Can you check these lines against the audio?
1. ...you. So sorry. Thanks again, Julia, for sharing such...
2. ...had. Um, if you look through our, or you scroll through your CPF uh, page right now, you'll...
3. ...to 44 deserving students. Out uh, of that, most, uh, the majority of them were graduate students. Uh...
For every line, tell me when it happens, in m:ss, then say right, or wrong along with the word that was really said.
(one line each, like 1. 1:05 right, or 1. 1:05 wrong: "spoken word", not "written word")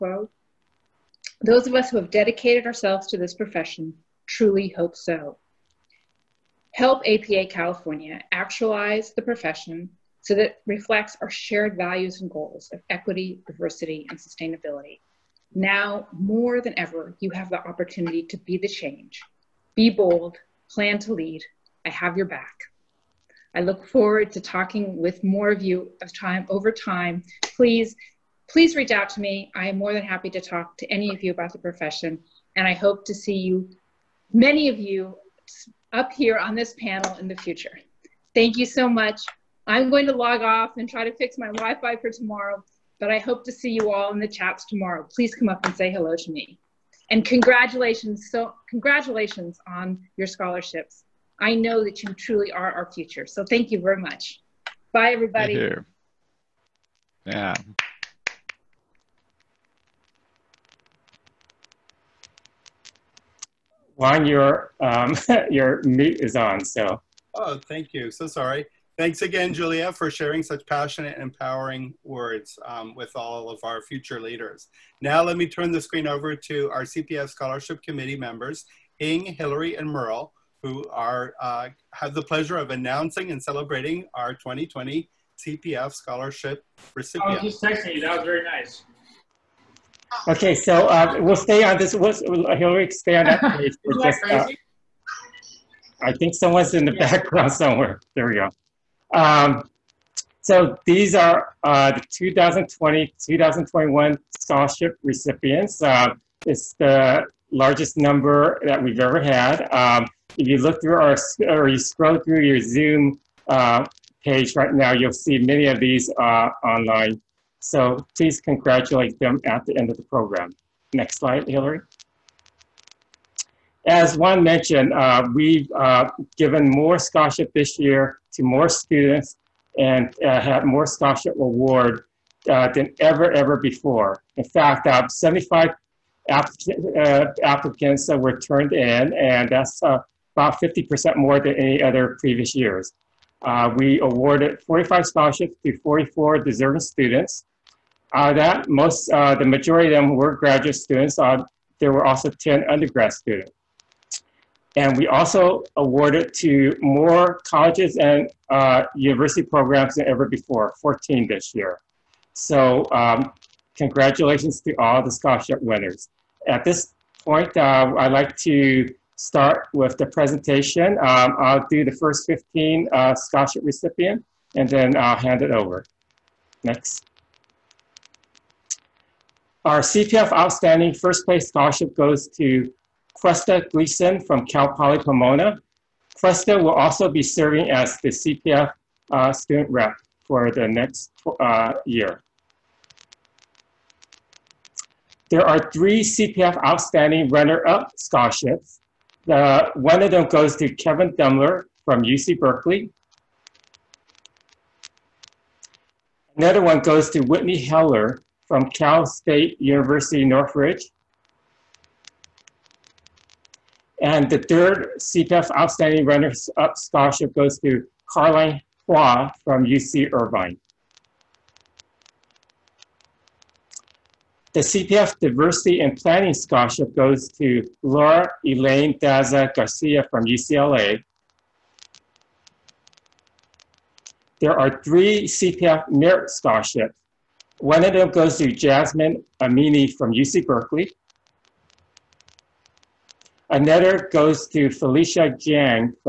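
1. 1:07 right
2. 1:49 wrong: "Zoom", not "CPF"
3. 2:25 right.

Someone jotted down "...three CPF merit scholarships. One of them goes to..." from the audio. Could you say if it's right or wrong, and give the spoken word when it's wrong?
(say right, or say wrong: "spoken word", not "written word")
right.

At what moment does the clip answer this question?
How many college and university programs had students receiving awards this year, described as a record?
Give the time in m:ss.
2:40.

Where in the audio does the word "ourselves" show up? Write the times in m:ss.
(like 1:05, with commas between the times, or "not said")
0:02.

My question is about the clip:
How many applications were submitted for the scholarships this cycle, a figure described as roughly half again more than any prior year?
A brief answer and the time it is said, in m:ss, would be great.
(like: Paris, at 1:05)
75, at 2:15.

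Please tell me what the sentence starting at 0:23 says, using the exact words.
I look forward to talking with more of you of time over time.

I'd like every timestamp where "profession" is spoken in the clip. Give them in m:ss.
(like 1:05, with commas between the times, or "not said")
0:03, 0:09, 0:31.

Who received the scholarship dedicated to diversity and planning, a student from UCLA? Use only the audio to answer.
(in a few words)
Laura Elaine Daza Garcia.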